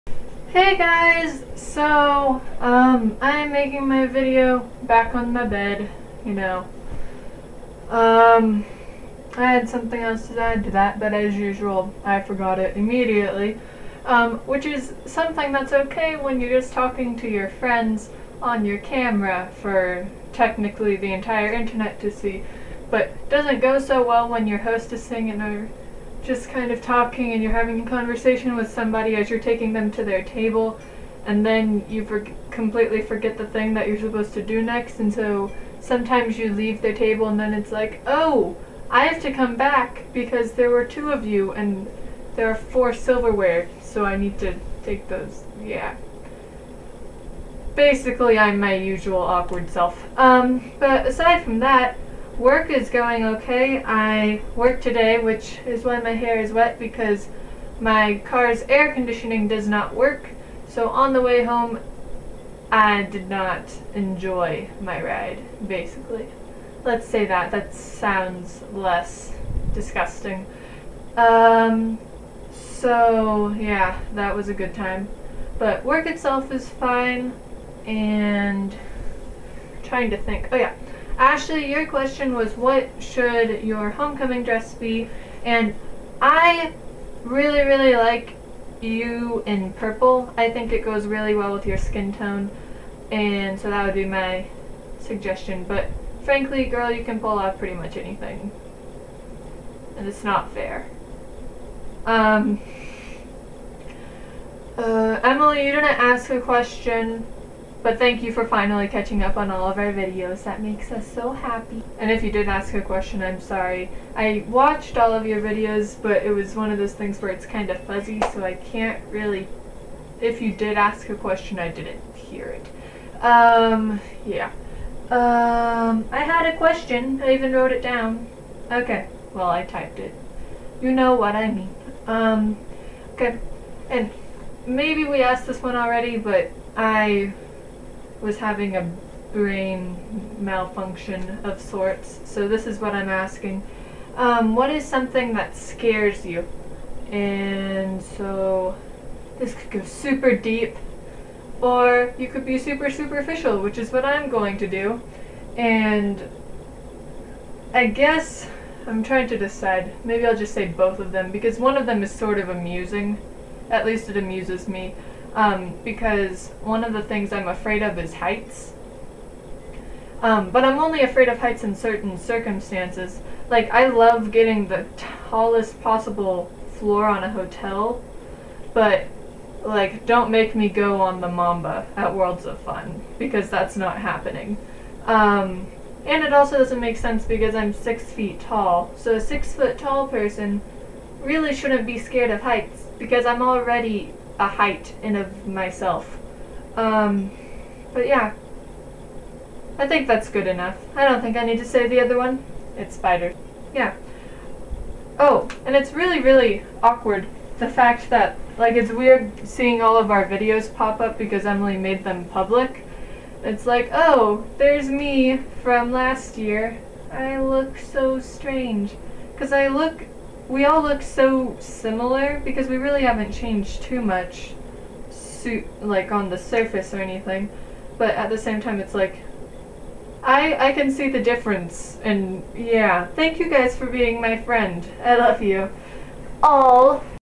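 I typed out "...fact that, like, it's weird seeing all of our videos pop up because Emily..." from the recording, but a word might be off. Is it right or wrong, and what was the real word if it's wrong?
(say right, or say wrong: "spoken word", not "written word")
right.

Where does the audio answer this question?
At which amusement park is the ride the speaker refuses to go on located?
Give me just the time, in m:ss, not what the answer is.
3:02.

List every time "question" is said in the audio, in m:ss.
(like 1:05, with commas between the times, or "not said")
1:21, 1:46, 1:52, 2:01, 2:06.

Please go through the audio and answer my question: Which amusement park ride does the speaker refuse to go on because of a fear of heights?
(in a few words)
The Mamba.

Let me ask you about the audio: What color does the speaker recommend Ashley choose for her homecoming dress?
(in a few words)
Purple.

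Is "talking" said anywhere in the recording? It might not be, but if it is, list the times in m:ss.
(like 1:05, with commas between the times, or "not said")
0:16, 0:26.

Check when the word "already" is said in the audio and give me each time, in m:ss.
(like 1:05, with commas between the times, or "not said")
2:15, 3:13.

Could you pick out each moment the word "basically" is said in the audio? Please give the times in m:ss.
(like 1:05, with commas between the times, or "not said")
0:47, 1:05.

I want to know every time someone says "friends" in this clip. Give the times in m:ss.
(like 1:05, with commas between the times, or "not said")
0:17, 3:54.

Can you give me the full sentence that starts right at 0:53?
I worked today, which is why my hair is wet because my car's air conditioning does not work.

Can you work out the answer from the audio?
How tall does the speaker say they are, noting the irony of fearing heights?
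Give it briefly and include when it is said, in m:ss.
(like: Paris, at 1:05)
6 feet, at 3:07.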